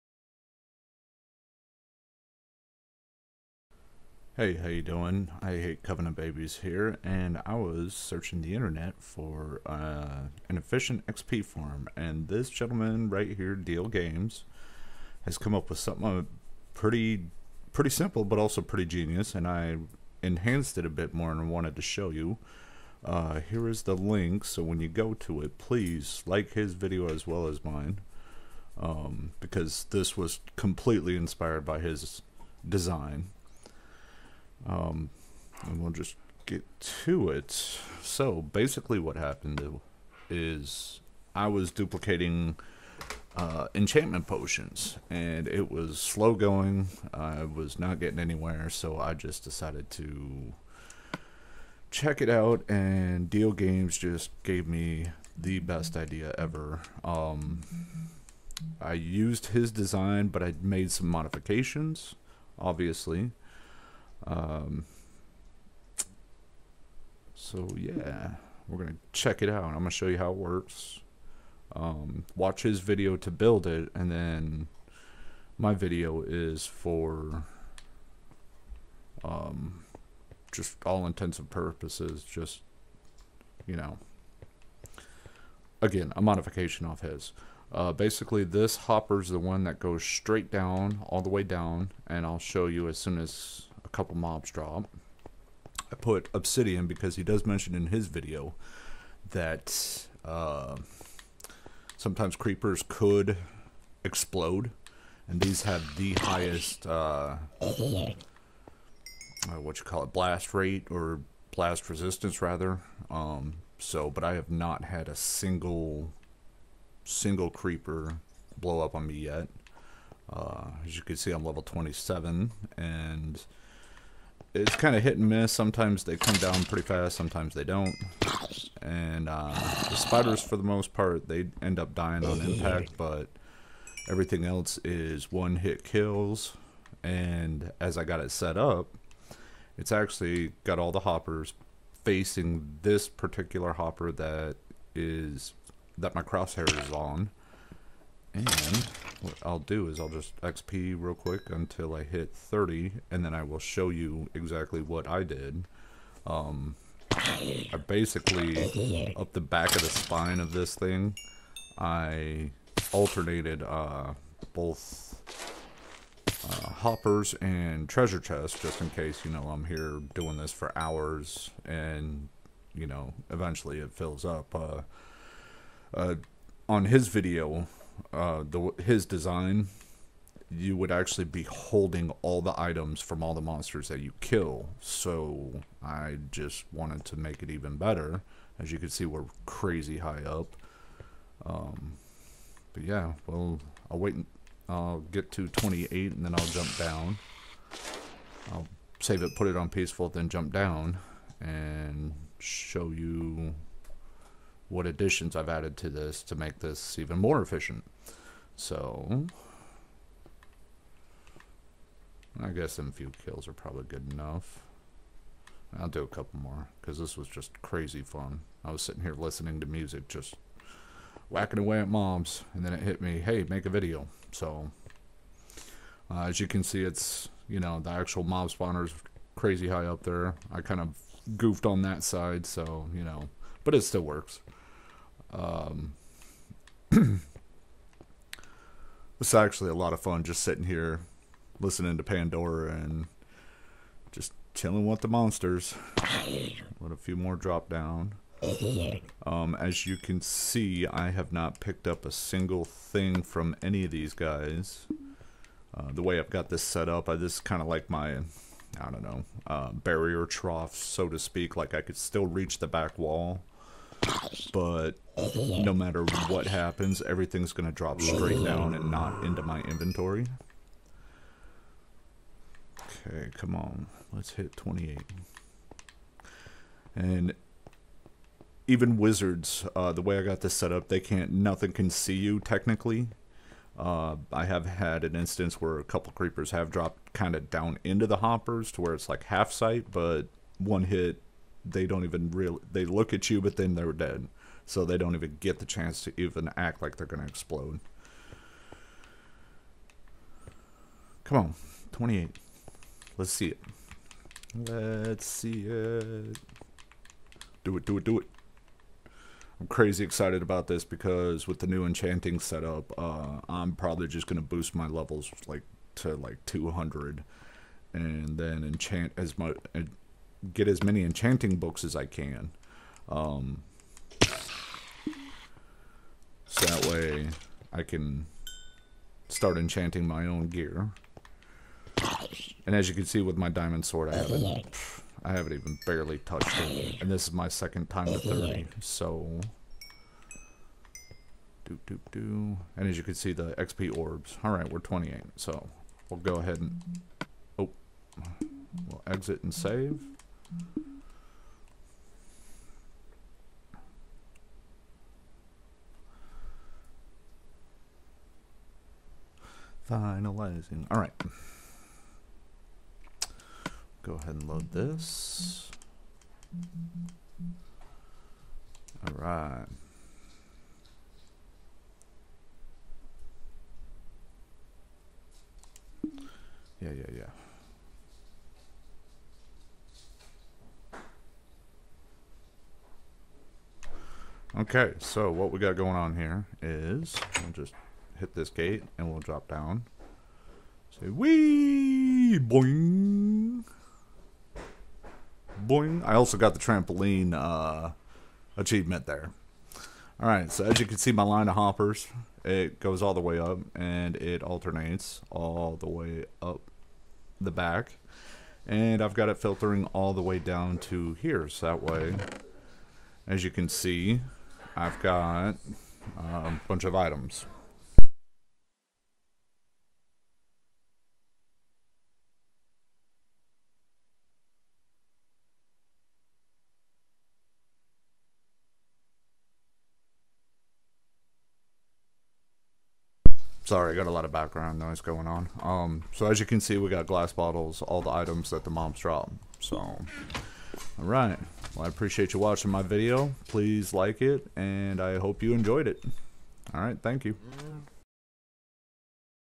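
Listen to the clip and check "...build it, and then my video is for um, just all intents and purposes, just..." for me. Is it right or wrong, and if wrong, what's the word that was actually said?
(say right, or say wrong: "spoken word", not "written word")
right.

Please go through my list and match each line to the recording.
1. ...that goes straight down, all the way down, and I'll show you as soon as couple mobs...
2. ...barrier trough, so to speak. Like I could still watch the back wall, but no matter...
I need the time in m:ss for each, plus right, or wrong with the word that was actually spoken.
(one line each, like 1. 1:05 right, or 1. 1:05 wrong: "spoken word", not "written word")
1. 1:29 right
2. 4:19 wrong: "reach", not "watch".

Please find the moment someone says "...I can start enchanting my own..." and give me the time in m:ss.
5:27.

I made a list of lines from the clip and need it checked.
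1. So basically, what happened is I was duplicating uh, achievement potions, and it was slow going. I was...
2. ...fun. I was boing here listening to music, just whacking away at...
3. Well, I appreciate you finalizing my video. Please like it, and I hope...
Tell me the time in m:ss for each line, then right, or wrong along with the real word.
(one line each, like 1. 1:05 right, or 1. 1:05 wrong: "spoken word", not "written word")
1. 0:38 wrong: "enchantment", not "achievement"
2. 3:38 wrong: "sitting", not "boing"
3. 7:21 wrong: "watching", not "finalizing".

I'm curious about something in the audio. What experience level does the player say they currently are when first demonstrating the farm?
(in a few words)
27.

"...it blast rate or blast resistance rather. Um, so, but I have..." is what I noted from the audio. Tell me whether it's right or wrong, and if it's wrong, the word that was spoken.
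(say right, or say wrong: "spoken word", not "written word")
right.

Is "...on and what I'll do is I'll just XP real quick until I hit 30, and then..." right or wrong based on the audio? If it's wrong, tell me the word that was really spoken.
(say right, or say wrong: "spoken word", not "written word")
right.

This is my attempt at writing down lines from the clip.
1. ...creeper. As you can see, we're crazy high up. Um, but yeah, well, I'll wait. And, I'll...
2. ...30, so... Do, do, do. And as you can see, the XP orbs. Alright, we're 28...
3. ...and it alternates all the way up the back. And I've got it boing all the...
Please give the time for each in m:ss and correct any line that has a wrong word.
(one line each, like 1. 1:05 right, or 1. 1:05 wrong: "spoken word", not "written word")
1. 3:07 wrong: "better", not "creeper"
2. 5:38 right
3. 6:43 wrong: "filtering", not "boing".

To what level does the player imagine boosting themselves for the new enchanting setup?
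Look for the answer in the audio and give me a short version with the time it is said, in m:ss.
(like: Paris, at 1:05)
200, at 5:16.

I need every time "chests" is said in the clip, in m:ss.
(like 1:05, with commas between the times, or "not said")
2:48.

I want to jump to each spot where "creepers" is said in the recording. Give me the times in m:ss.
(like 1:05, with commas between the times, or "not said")
1:42, 1:57, 4:46.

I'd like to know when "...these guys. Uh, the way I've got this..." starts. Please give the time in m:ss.
4:13.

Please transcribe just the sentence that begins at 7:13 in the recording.
Sorry, I got a lot of background noise going on.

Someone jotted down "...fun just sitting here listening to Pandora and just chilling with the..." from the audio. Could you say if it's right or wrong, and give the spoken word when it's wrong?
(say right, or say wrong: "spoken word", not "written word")
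right.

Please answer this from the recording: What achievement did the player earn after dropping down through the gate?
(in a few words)
trampoline.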